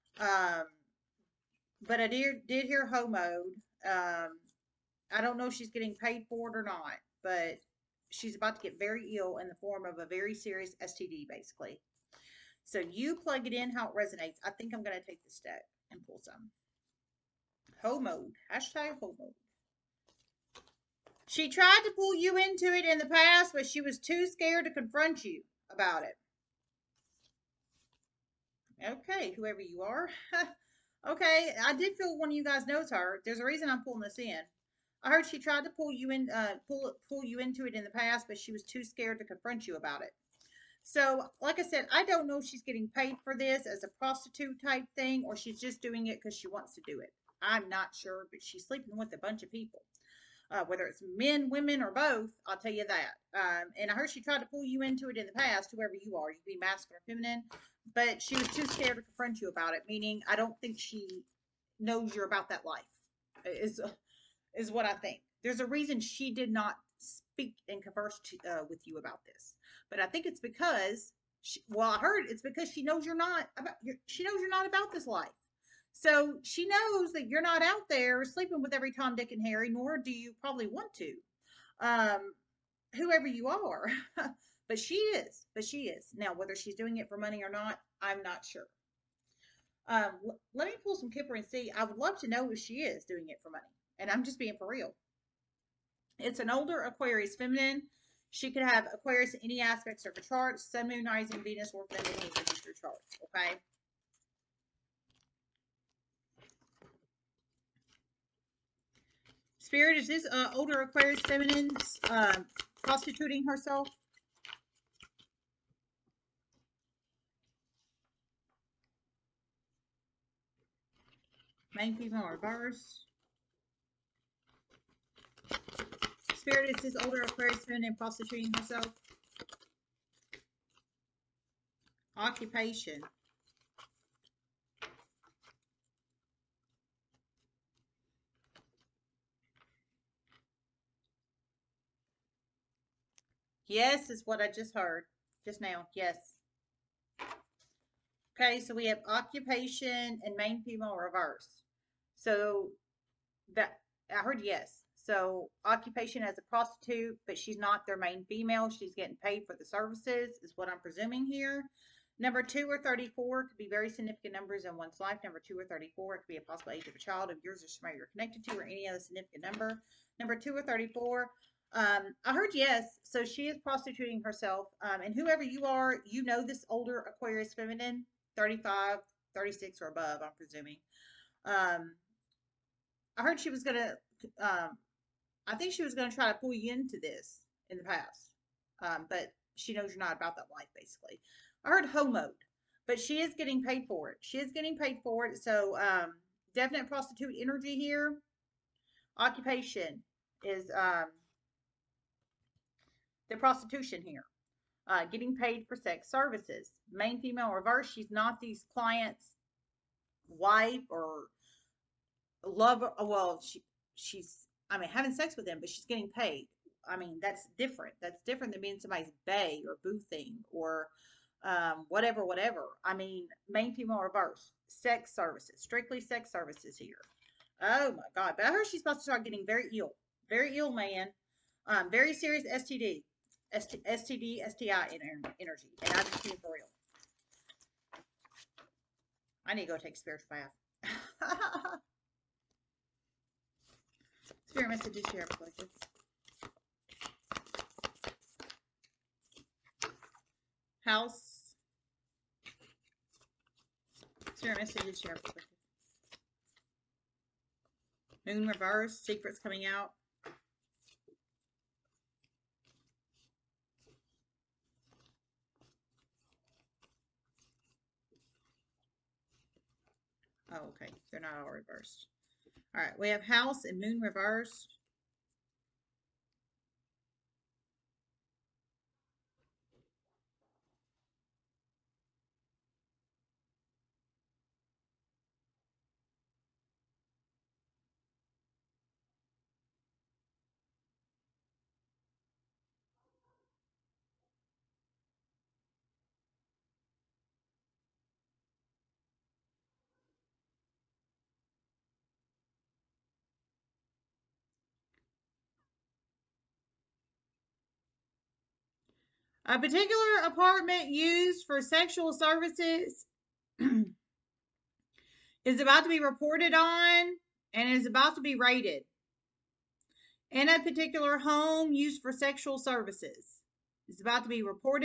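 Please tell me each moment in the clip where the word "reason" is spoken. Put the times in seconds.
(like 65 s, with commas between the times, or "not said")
33 s, 65 s.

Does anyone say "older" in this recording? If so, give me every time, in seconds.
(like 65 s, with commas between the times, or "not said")
96 s, 110 s, 127 s, 176 s.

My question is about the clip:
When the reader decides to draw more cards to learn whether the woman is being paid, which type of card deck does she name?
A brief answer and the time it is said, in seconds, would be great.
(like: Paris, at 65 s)
Kipper, at 91 s.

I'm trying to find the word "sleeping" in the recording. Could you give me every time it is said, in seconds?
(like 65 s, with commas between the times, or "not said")
48 s, 78 s.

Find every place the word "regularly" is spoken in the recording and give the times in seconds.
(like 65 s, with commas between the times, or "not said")
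not said.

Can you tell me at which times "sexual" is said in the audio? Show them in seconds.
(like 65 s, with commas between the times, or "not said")
311 s, 322 s.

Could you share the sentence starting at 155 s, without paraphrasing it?
So occupation as a prostitute, but she's not their main female.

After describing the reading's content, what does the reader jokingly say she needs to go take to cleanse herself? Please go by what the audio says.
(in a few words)
a spiritual bath.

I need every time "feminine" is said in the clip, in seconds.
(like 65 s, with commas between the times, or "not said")
57 s, 97 s, 101 s, 111 s, 177 s.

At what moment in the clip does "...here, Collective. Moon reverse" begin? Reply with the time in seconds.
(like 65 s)
254 s.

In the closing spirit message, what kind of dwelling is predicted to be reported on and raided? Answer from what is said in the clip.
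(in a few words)
apartment.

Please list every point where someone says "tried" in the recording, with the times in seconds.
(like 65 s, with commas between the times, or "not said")
21 s, 35 s, 54 s.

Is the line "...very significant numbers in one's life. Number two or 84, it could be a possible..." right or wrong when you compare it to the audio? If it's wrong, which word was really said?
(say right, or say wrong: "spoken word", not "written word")
wrong: "34", not "84".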